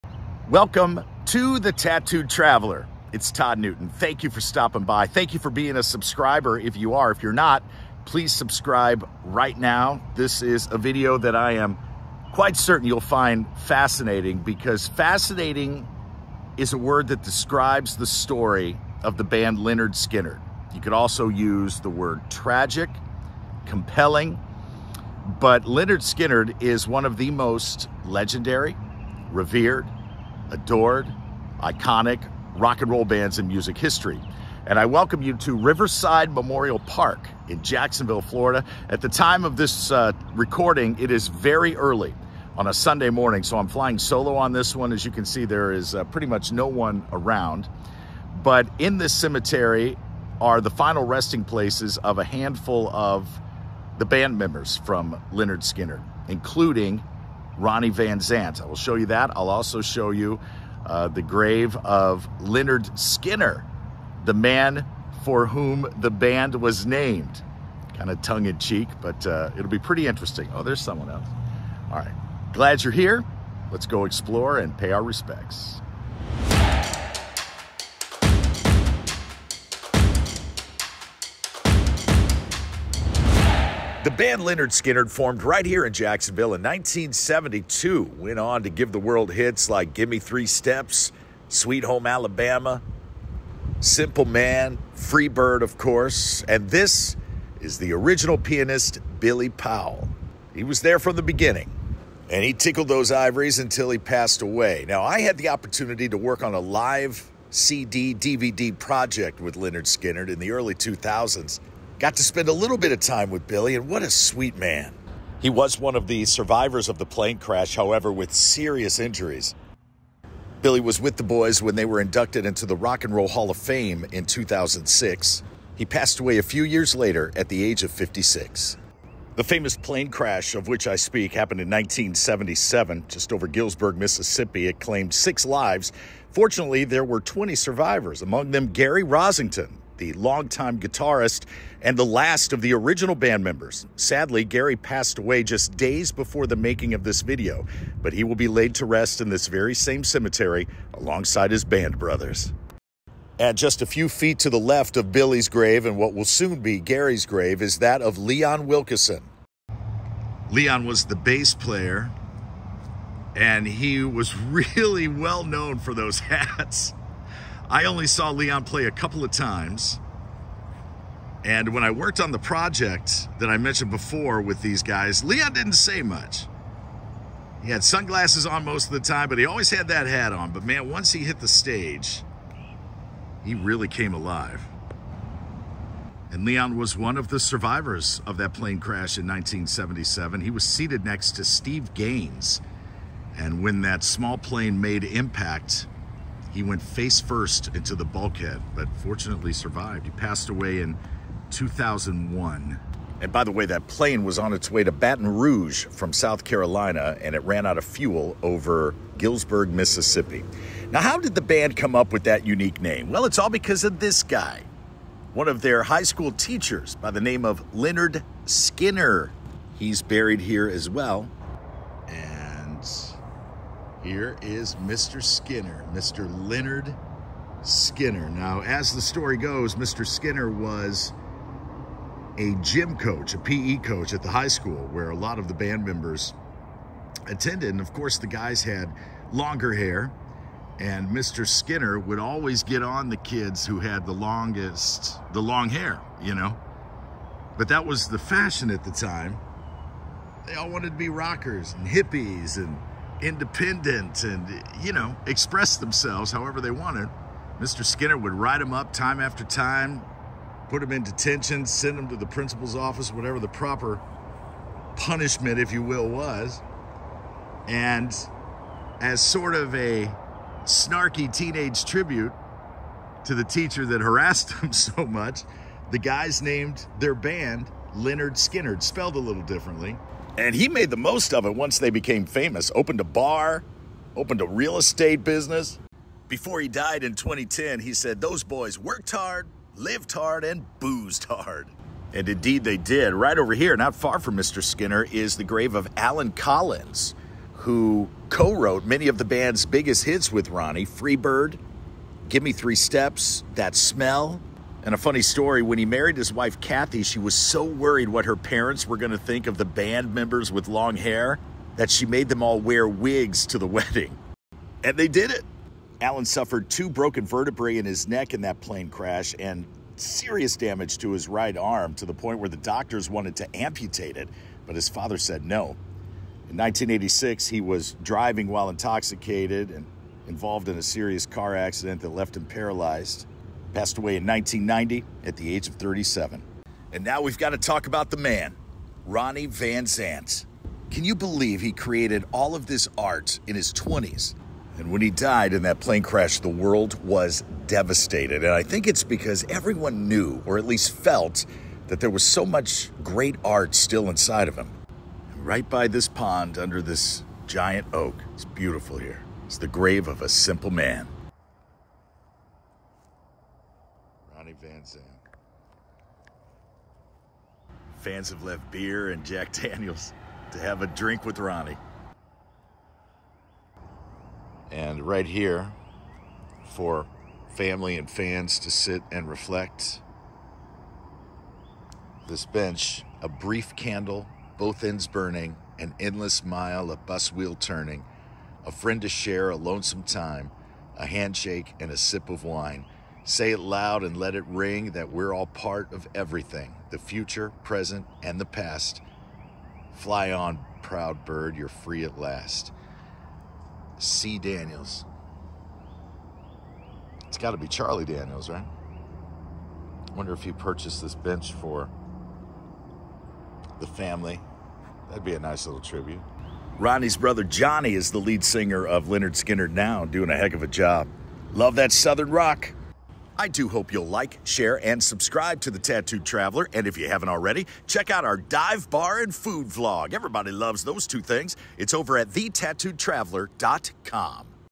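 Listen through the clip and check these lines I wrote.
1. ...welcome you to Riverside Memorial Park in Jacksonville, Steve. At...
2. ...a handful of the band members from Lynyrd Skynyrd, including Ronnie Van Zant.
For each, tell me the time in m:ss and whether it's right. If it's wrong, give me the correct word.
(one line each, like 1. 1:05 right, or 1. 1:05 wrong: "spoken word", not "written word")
1. 0:34 wrong: "Florida", not "Steve"
2. 0:52 right.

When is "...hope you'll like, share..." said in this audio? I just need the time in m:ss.
7:03.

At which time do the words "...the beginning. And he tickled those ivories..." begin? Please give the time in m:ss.
1:41.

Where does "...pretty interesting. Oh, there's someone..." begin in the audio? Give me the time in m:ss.
1:09.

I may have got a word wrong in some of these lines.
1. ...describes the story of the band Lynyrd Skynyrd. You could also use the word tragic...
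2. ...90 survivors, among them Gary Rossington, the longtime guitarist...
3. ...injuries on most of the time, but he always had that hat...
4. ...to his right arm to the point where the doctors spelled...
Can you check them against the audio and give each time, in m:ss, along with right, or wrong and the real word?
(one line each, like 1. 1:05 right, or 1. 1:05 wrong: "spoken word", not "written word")
1. 0:17 right
2. 2:17 wrong: "20", not "90"
3. 2:57 wrong: "sunglasses", not "injuries"
4. 5:20 wrong: "wanted", not "spelled".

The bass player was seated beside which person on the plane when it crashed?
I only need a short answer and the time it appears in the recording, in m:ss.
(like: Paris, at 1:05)
Steve Gaines, at 3:11.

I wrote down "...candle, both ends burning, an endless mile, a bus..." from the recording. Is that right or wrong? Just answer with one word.
right.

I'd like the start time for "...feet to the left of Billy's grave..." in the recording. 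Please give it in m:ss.
2:34.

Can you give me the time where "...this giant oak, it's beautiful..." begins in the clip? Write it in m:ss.
5:56.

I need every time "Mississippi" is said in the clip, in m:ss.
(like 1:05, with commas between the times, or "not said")
2:13, 3:29.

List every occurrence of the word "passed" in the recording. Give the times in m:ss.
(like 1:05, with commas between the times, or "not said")
1:43, 2:05, 2:24, 3:20, 5:33.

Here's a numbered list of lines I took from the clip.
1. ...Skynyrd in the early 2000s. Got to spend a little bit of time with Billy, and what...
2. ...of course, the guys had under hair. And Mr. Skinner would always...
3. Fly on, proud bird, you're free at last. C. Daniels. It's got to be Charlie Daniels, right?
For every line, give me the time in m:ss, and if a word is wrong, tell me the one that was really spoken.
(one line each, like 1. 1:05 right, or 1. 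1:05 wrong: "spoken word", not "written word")
1. 1:49 right
2. 3:57 wrong: "longer", not "under"
3. 6:39 right.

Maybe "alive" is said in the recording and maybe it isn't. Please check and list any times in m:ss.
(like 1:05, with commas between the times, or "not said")
3:04.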